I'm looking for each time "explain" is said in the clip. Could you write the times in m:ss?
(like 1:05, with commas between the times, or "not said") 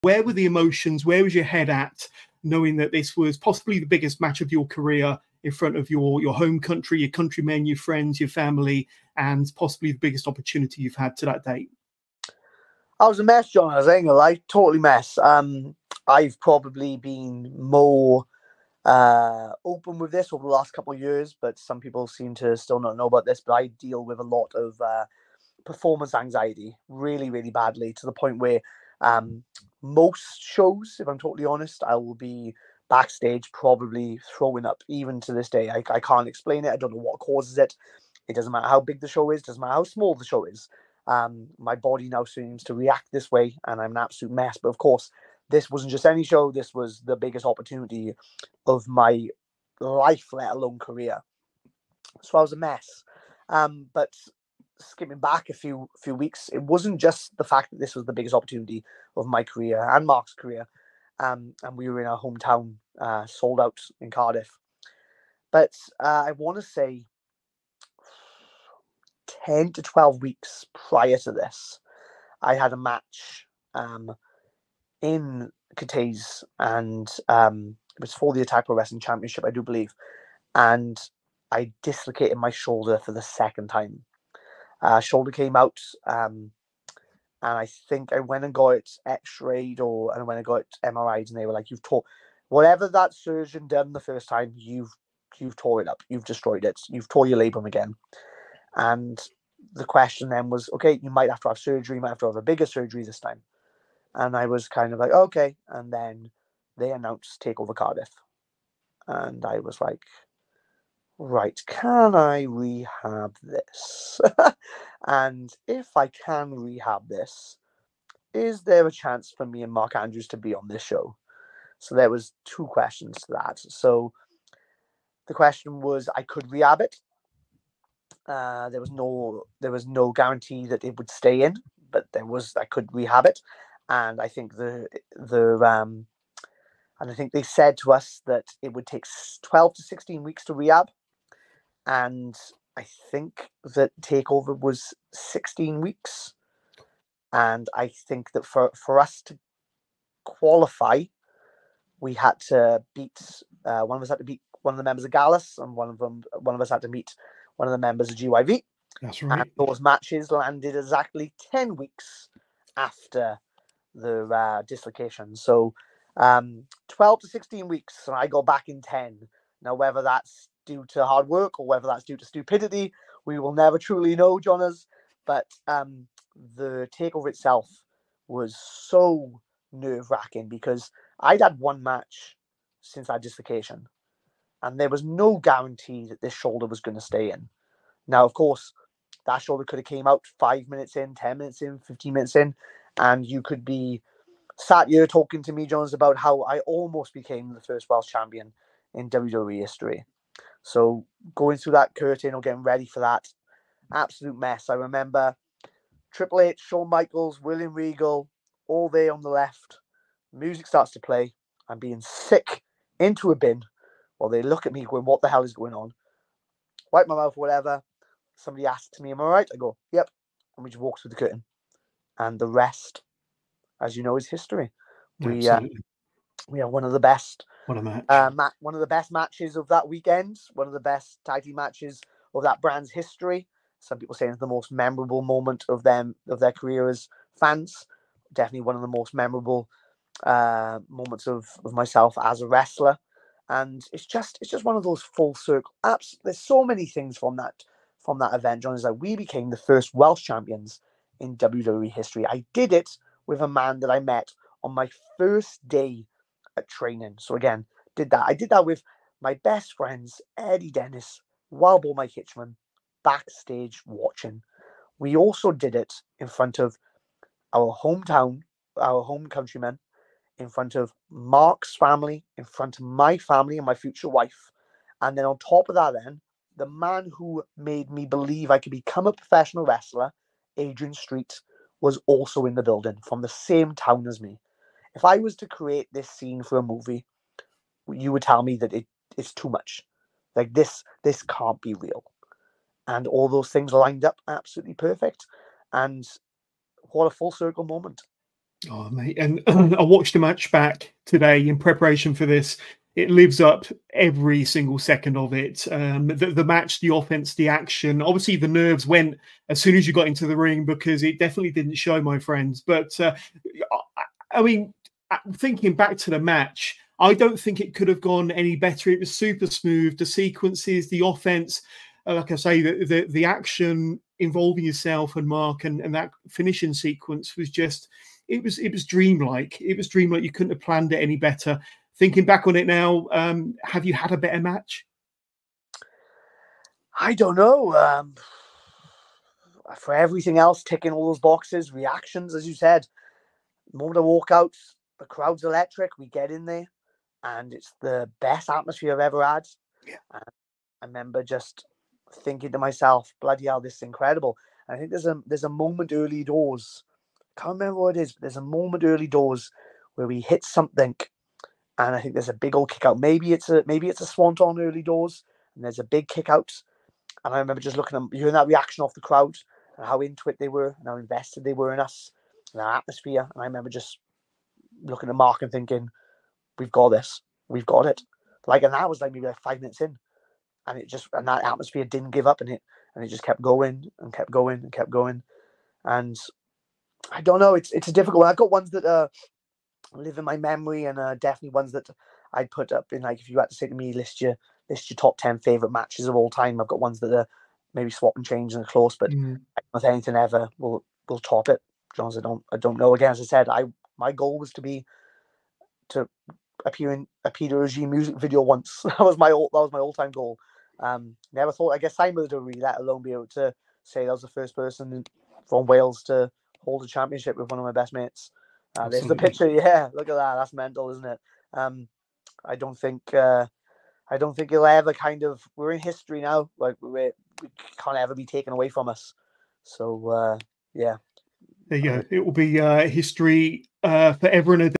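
0:36.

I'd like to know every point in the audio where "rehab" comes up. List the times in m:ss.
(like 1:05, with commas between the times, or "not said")
1:52, 1:56, 2:06, 2:12, 2:20.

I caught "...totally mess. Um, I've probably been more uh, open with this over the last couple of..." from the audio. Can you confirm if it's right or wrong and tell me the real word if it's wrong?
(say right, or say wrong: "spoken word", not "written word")
right.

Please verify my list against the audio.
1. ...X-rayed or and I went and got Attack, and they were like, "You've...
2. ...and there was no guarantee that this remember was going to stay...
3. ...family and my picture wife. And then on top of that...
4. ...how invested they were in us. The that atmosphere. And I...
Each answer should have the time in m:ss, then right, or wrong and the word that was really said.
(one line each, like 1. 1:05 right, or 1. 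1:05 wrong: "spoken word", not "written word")
1. 1:29 wrong: "MRIs", not "Attack"
2. 3:04 wrong: "shoulder", not "remember"
3. 4:33 wrong: "future", not "picture"
4. 6:10 right.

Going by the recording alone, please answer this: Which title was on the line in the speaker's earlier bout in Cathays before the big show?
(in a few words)
Attack Pro Wrestling Championship.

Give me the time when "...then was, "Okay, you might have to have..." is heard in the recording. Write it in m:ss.
1:40.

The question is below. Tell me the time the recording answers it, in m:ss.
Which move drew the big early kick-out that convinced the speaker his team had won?
6:04.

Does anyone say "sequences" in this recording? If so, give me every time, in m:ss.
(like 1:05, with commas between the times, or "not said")
5:20, 5:26.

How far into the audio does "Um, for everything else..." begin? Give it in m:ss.
5:37.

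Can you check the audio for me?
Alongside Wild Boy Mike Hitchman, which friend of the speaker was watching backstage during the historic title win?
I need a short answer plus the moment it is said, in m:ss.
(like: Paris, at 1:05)
Eddie Dennis, at 4:20.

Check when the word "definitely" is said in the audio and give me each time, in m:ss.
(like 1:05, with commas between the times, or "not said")
3:58, 5:11, 6:31.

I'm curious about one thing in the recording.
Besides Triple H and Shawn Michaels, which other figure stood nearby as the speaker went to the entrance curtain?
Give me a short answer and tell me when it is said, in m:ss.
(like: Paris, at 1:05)
William Regal, at 3:27.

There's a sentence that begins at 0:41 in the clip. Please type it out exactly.
Um, my body now seems to react this way, and I'm an absolute mess.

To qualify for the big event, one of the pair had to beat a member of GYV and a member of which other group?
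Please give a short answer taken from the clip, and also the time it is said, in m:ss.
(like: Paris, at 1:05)
Gallus, at 2:35.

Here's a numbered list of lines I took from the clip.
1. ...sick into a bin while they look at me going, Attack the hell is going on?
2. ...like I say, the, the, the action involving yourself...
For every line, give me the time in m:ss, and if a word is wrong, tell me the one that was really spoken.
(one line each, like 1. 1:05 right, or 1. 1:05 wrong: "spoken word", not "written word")
1. 3:32 wrong: "What", not "Attack"
2. 5:22 right.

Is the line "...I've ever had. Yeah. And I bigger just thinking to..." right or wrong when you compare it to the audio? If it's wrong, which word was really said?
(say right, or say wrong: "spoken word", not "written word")
wrong: "remember", not "bigger".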